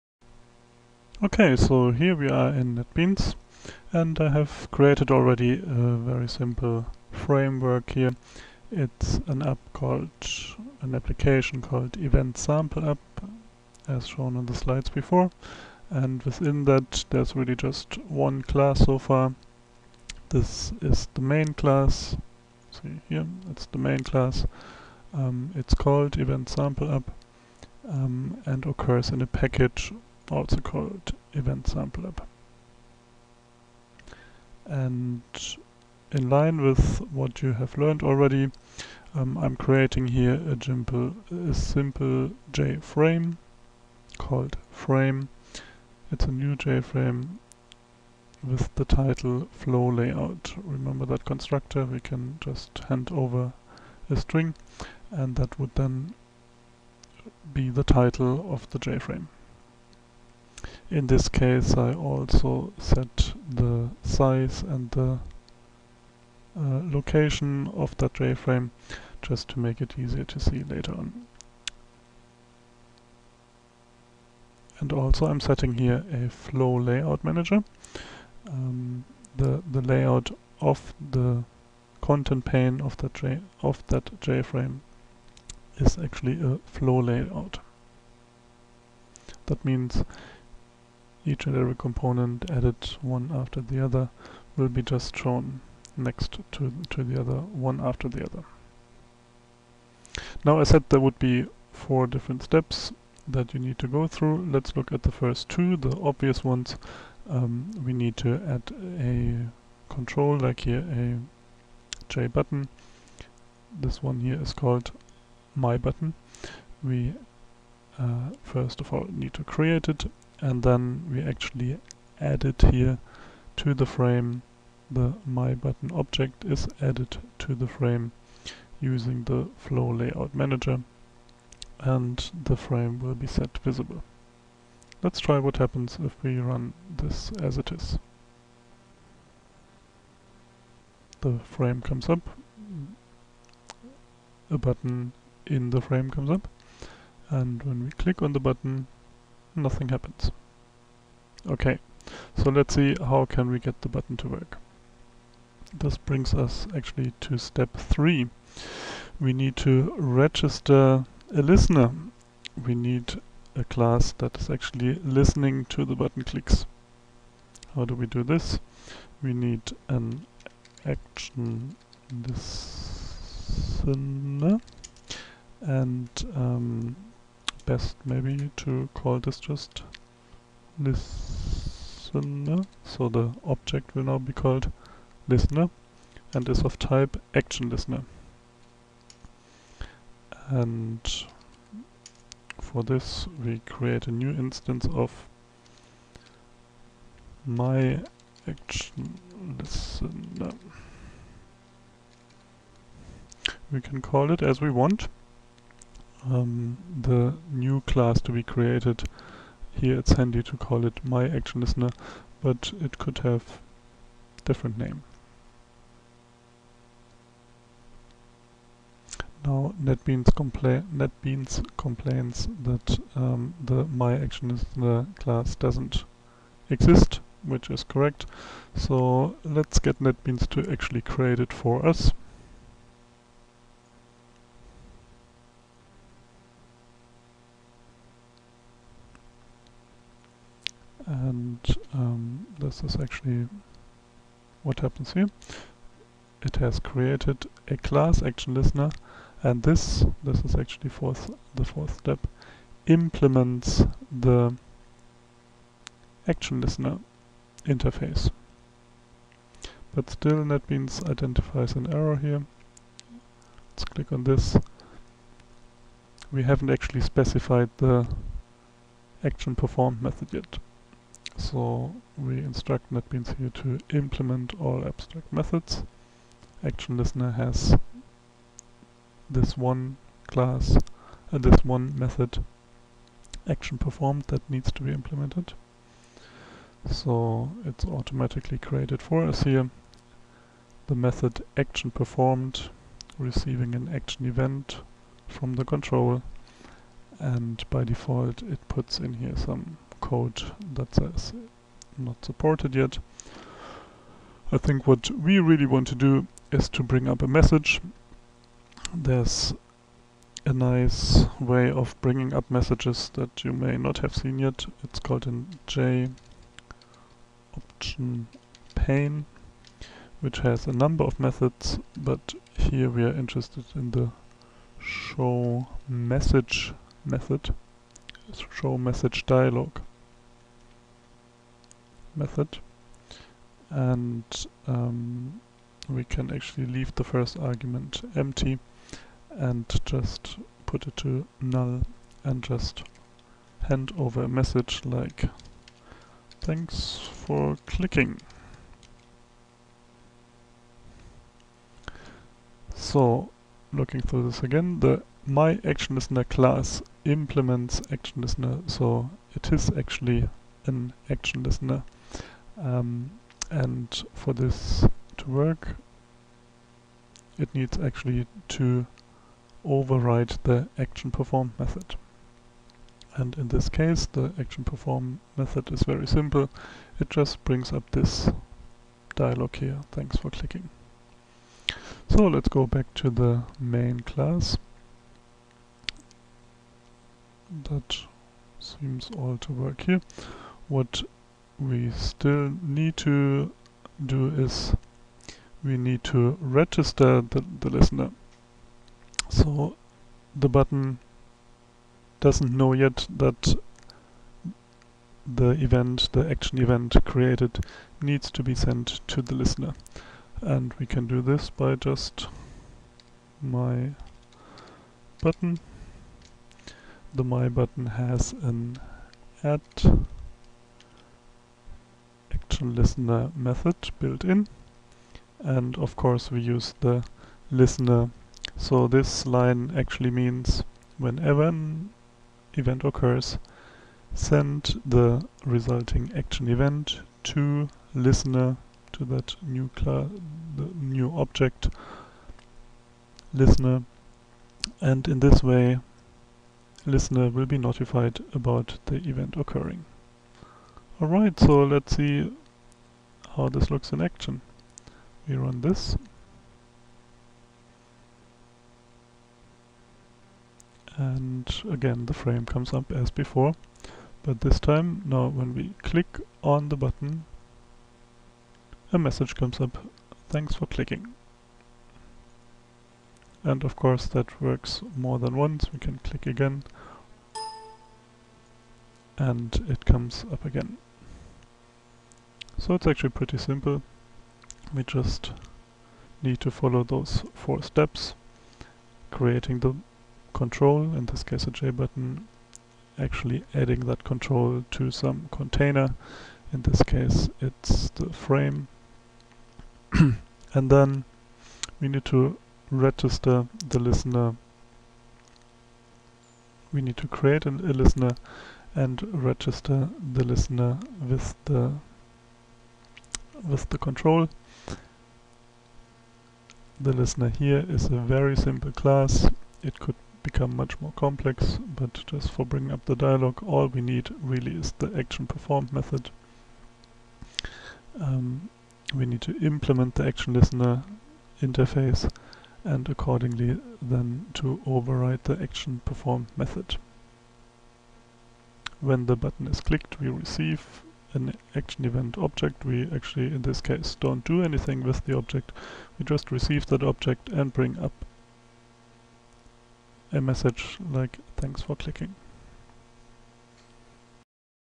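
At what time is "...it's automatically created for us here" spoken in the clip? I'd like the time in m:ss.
4:47.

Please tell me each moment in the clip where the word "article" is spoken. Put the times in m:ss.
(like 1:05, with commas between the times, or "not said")
not said.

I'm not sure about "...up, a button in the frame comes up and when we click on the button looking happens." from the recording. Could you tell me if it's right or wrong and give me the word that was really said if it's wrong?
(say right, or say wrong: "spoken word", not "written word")
wrong: "nothing", not "looking".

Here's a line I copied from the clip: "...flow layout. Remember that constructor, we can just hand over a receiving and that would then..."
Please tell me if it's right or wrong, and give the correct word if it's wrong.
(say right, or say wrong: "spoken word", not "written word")
wrong: "string", not "receiving".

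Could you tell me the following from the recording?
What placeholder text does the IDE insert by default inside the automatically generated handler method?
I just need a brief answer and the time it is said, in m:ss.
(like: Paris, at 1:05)
not supported yet, at 5:01.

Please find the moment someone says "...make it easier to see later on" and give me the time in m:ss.
1:09.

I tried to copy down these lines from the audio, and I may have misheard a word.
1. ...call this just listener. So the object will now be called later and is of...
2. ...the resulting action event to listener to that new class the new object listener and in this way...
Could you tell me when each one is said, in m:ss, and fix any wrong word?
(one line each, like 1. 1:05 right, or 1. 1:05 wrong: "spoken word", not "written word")
1. 2:58 wrong: "listener", not "later"
2. 7:14 right.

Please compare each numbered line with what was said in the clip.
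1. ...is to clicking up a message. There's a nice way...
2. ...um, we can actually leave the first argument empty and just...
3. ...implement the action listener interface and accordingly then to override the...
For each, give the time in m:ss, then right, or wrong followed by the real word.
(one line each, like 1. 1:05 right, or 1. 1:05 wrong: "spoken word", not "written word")
1. 5:06 wrong: "bring", not "clicking"
2. 5:34 right
3. 8:49 right.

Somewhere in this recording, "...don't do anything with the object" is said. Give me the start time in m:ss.
9:03.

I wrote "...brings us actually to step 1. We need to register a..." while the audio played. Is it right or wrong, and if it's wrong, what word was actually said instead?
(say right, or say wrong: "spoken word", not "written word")
wrong: "3", not "1".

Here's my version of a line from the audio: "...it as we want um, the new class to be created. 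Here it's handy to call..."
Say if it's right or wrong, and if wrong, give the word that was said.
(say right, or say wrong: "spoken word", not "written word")
right.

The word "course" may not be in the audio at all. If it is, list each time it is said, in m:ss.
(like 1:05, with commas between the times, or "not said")
7:05, 7:53.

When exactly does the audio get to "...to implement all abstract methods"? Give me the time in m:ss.
4:33.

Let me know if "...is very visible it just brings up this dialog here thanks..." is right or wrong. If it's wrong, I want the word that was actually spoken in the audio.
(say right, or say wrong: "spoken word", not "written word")
wrong: "simple", not "visible".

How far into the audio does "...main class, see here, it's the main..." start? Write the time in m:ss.
0:21.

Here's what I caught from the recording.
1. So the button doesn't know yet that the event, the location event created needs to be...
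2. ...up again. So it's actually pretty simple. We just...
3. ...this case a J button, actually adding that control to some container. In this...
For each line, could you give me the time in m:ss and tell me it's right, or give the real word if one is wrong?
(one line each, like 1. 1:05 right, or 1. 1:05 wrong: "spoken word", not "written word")
1. 6:39 wrong: "action", not "location"
2. 8:00 right
3. 8:11 right.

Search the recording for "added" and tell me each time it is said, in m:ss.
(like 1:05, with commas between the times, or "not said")
1:32, 2:06.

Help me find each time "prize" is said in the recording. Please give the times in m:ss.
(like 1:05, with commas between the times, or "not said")
not said.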